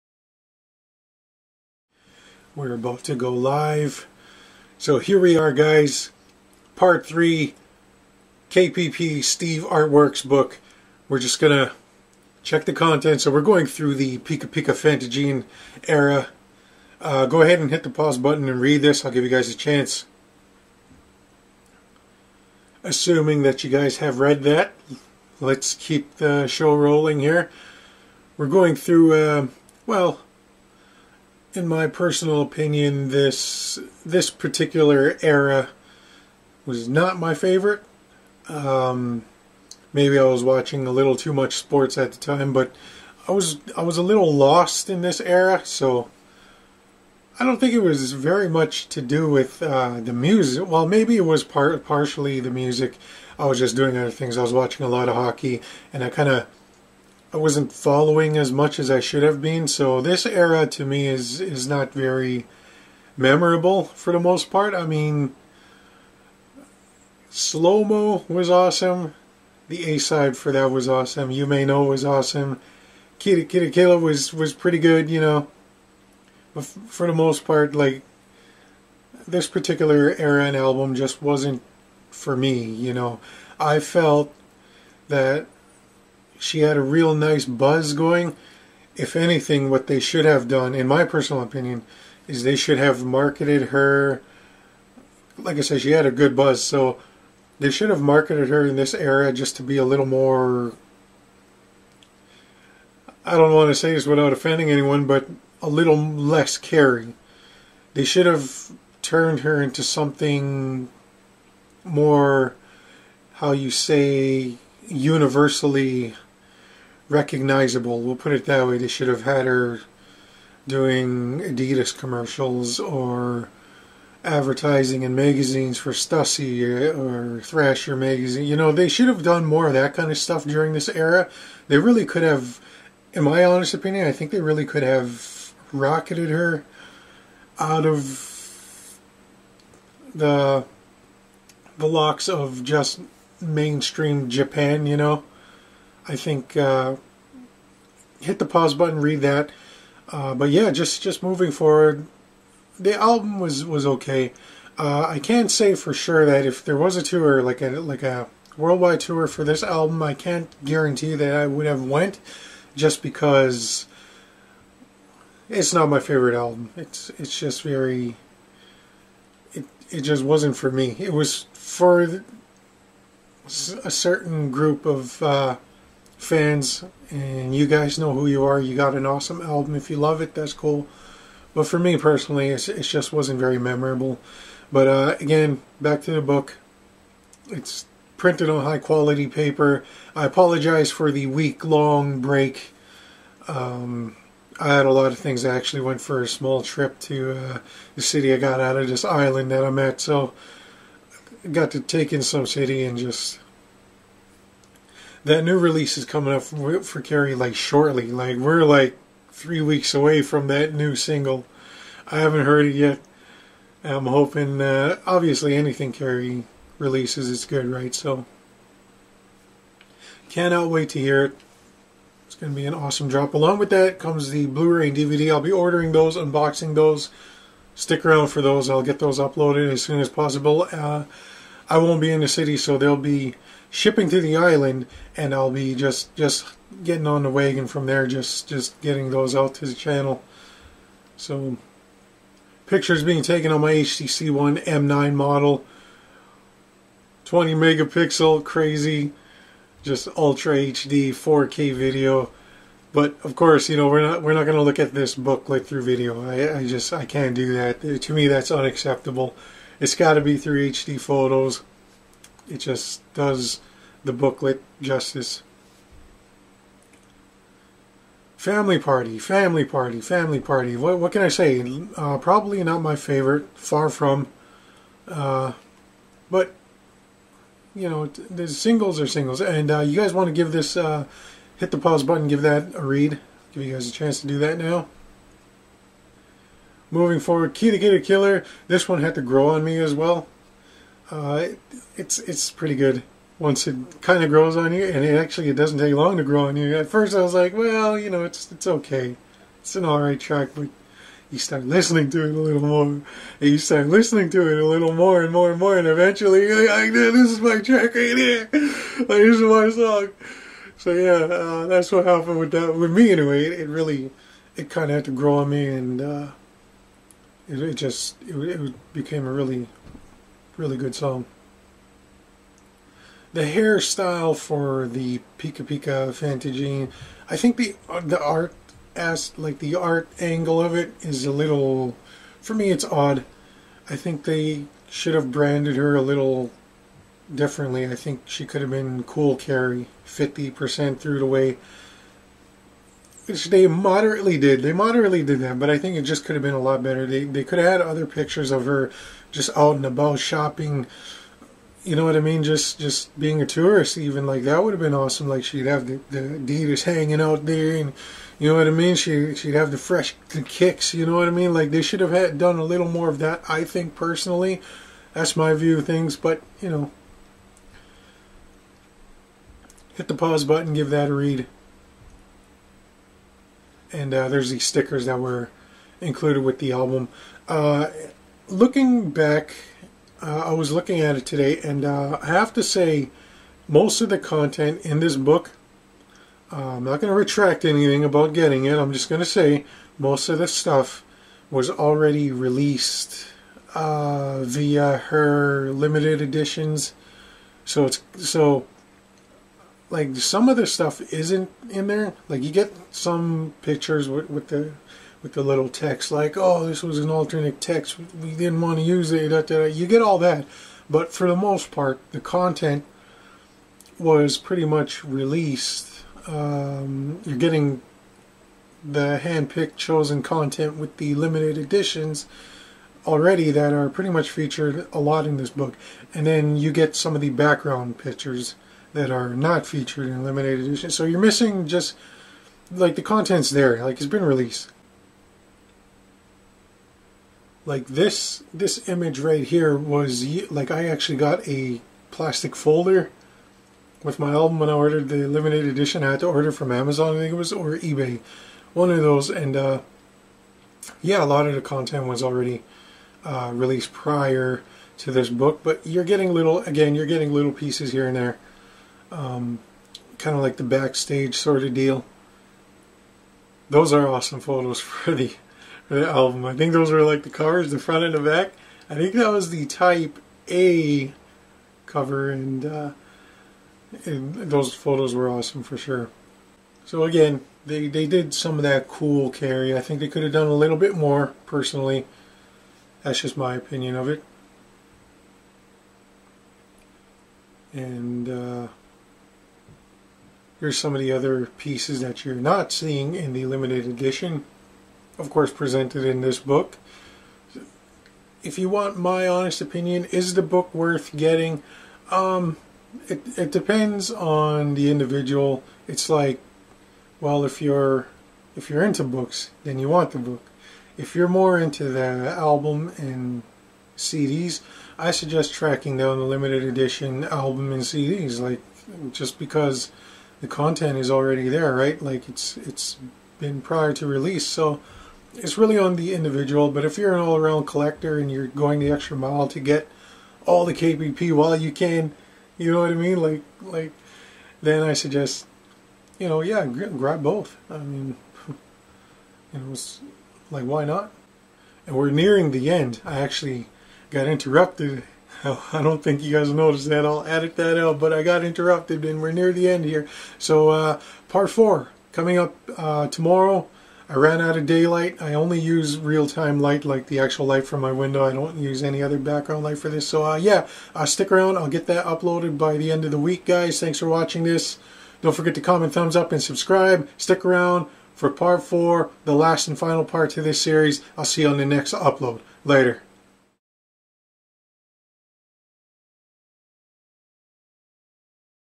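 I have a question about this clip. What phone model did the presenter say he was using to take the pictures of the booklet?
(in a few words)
HTC One M9.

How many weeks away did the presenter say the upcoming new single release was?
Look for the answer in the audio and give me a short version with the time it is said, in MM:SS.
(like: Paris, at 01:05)
3, at 03:29.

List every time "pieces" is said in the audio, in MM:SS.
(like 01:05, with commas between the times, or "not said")
07:37, 08:11.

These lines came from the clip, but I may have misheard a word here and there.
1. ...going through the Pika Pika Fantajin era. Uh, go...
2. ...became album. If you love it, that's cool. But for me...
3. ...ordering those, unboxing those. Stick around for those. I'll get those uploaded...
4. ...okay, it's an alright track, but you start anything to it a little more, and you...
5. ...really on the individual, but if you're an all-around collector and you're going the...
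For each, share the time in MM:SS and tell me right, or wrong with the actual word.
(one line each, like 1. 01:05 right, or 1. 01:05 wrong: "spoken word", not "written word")
1. 00:13 right
2. 02:59 wrong: "awesome", not "became"
3. 03:45 right
4. 04:58 wrong: "listening", not "anything"
5. 08:45 right.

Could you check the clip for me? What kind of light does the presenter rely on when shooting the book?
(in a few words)
Real-time light.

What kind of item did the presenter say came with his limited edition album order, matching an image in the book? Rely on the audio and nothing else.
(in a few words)
Plastic folder.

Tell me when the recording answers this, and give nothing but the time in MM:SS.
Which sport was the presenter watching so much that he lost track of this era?
00:55.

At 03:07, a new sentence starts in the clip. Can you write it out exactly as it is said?
It's printed on high quality paper.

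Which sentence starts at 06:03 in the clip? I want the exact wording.
I think personally, that's my view of things.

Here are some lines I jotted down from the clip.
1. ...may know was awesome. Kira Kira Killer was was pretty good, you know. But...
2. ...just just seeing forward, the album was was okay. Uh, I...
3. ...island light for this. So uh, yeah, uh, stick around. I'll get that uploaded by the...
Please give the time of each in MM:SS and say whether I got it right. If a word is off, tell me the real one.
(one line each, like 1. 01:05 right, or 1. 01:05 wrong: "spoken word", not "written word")
1. 01:11 right
2. 02:30 wrong: "moving", not "seeing"
3. 09:19 wrong: "background", not "island".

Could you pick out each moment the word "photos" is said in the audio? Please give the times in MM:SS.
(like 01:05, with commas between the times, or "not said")
04:20, 07:44, 07:54.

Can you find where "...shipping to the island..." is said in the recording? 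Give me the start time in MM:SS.
03:53.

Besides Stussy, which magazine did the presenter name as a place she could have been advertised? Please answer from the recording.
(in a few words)
Thrasher.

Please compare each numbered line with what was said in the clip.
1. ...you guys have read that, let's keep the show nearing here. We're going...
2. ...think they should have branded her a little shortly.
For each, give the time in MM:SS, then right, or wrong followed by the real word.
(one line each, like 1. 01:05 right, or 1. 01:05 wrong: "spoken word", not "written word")
1. 00:23 wrong: "rolling", not "nearing"
2. 05:33 wrong: "differently", not "shortly".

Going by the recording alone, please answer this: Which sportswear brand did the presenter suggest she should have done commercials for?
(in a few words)
Adidas.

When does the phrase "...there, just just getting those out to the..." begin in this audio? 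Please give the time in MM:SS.
03:57.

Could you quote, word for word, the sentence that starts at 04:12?
But of course, you know we're not we're not going to look at this booklet through video.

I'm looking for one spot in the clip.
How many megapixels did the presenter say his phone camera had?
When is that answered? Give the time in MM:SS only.
04:07.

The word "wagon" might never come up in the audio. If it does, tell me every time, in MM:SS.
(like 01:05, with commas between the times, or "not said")
03:57.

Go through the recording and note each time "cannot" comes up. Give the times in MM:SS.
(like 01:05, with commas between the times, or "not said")
03:40.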